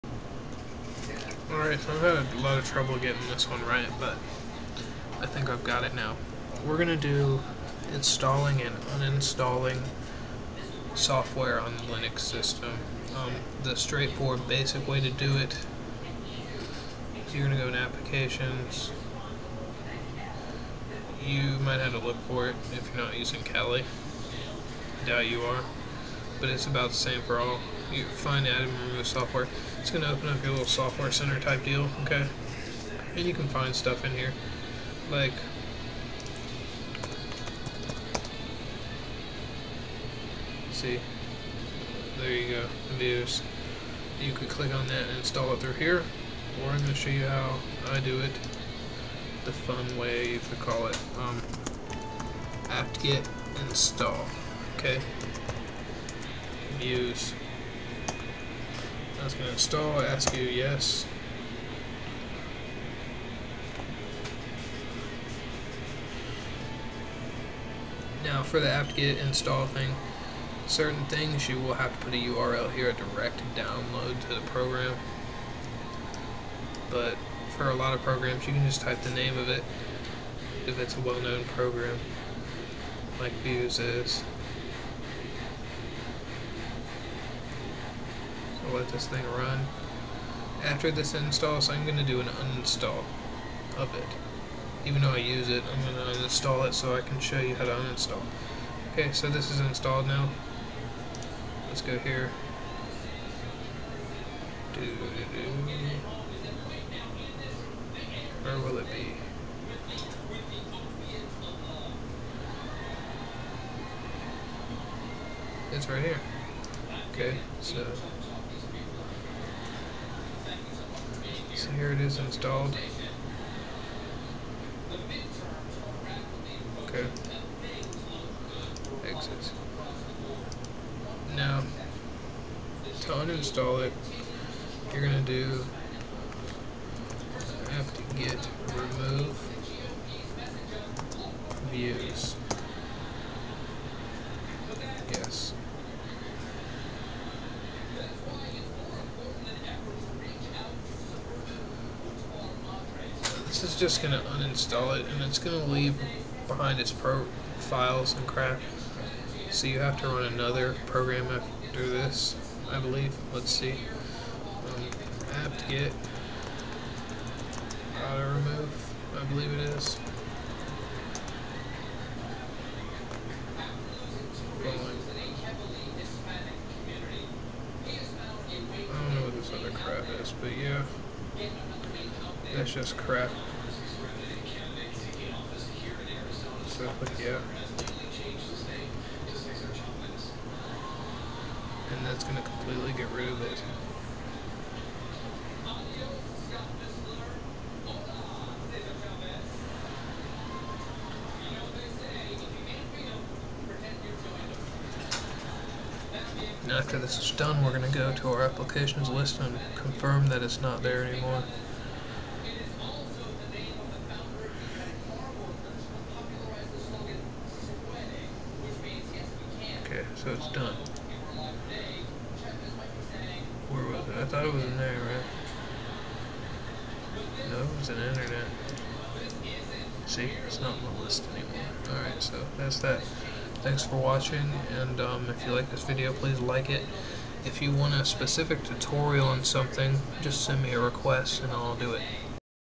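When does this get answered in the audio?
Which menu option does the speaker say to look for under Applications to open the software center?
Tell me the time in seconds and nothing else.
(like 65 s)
28 s.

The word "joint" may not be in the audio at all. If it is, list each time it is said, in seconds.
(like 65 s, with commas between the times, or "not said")
not said.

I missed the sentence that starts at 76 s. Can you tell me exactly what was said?
But for a lot of programs, you can just type the name of it if it's a well-known program, like Vuze is.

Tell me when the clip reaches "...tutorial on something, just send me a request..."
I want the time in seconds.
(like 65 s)
238 s.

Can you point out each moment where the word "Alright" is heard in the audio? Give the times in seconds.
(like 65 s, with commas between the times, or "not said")
1 s, 231 s.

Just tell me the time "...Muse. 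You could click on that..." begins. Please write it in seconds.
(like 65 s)
42 s.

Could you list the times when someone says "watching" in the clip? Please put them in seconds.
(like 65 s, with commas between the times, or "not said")
233 s.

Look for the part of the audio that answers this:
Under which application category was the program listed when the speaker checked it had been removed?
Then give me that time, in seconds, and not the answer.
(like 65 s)
227 s.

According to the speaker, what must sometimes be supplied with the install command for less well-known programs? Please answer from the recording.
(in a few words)
A URL.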